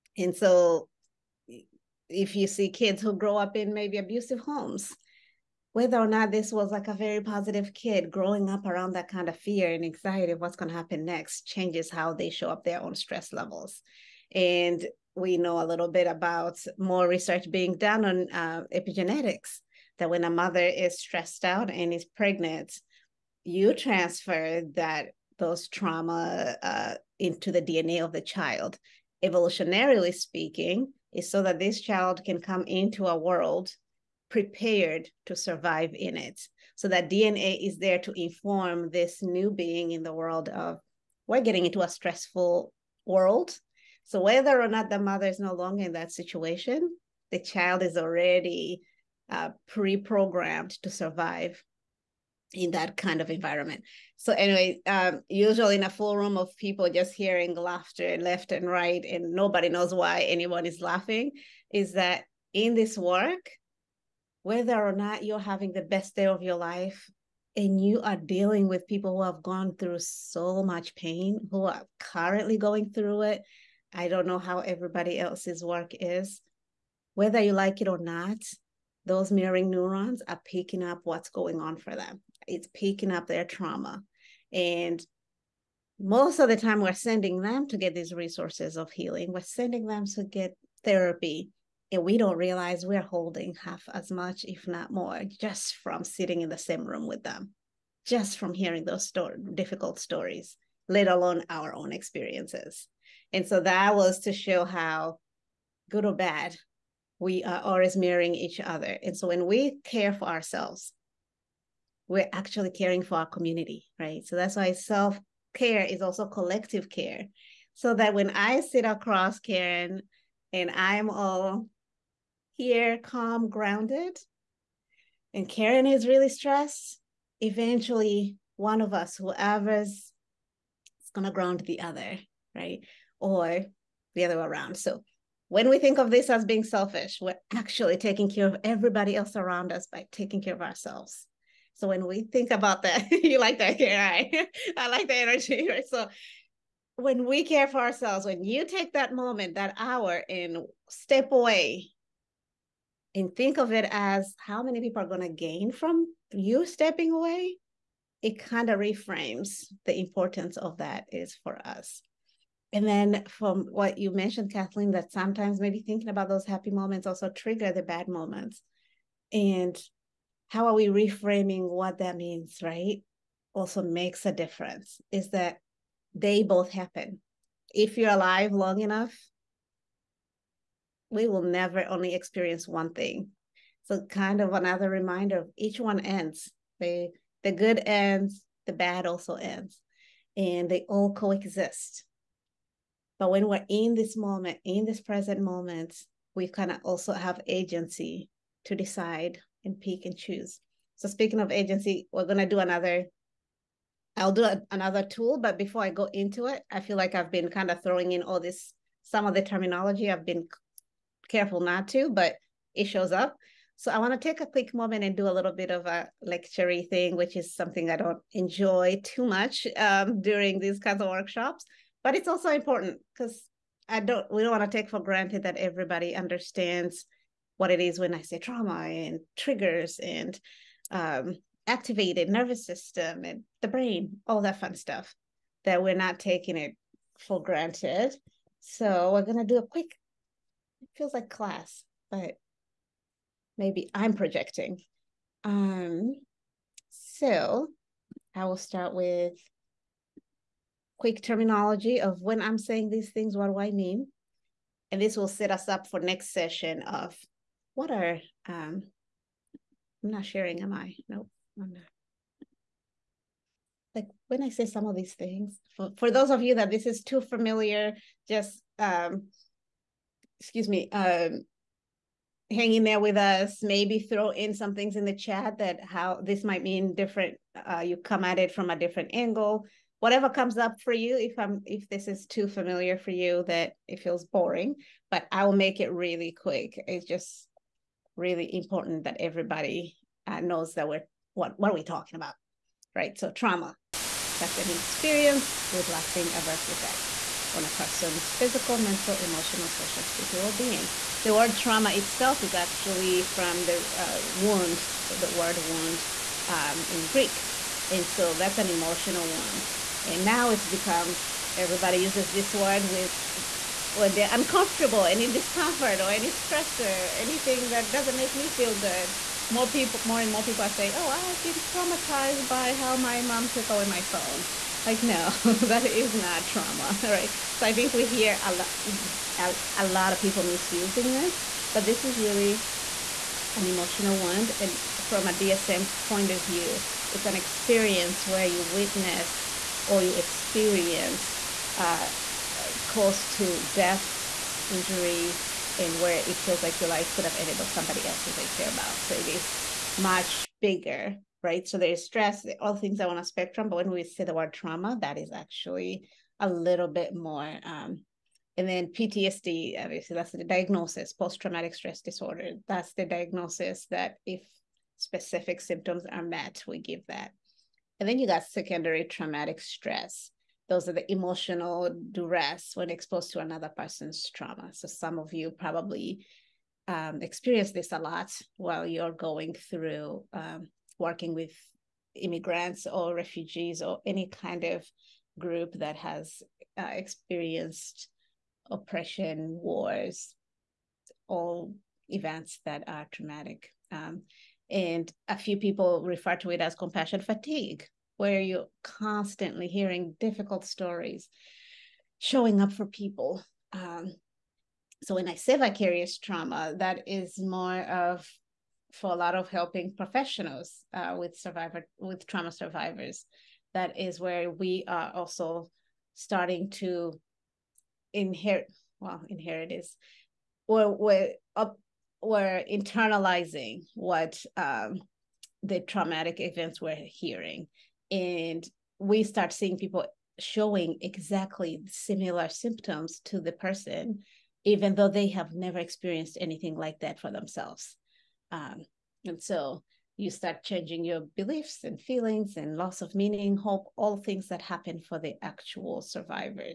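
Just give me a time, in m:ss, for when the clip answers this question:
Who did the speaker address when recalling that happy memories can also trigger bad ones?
2:44.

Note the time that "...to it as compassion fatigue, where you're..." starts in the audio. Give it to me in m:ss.
6:36.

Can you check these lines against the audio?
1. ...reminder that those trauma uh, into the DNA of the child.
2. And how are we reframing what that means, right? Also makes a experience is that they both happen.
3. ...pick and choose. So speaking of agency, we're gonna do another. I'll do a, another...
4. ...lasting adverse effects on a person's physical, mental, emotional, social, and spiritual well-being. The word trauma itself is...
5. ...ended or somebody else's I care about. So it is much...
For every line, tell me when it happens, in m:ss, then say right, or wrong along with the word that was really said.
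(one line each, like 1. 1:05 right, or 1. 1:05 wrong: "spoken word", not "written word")
1. 0:23 wrong: "transfer", not "reminder"
2. 2:49 wrong: "difference", not "experience"
3. 3:19 right
4. 4:55 right
5. 5:47 right.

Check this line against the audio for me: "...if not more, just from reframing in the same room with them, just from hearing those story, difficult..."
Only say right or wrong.
wrong.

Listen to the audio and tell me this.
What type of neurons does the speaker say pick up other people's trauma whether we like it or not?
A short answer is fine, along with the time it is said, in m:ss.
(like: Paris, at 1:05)
mirroring neurons, at 1:19.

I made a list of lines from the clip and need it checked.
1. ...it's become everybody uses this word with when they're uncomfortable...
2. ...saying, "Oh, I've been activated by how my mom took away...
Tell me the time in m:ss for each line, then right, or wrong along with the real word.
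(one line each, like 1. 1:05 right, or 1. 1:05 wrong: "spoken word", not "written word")
1. 5:10 right
2. 5:20 wrong: "traumatized", not "activated".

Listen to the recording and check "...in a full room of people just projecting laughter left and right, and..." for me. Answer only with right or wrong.
wrong.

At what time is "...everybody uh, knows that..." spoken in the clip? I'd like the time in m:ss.
4:49.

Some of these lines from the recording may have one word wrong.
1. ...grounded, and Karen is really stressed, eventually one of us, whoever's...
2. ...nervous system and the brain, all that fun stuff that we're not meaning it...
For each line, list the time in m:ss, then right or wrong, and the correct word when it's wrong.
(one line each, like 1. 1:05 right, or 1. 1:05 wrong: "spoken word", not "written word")
1. 2:03 right
2. 3:52 wrong: "taking", not "meaning".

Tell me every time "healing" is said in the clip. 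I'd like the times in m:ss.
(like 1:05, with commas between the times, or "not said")
1:28.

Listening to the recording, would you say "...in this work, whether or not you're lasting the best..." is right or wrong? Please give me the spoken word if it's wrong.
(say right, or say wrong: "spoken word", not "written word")
wrong: "having", not "lasting".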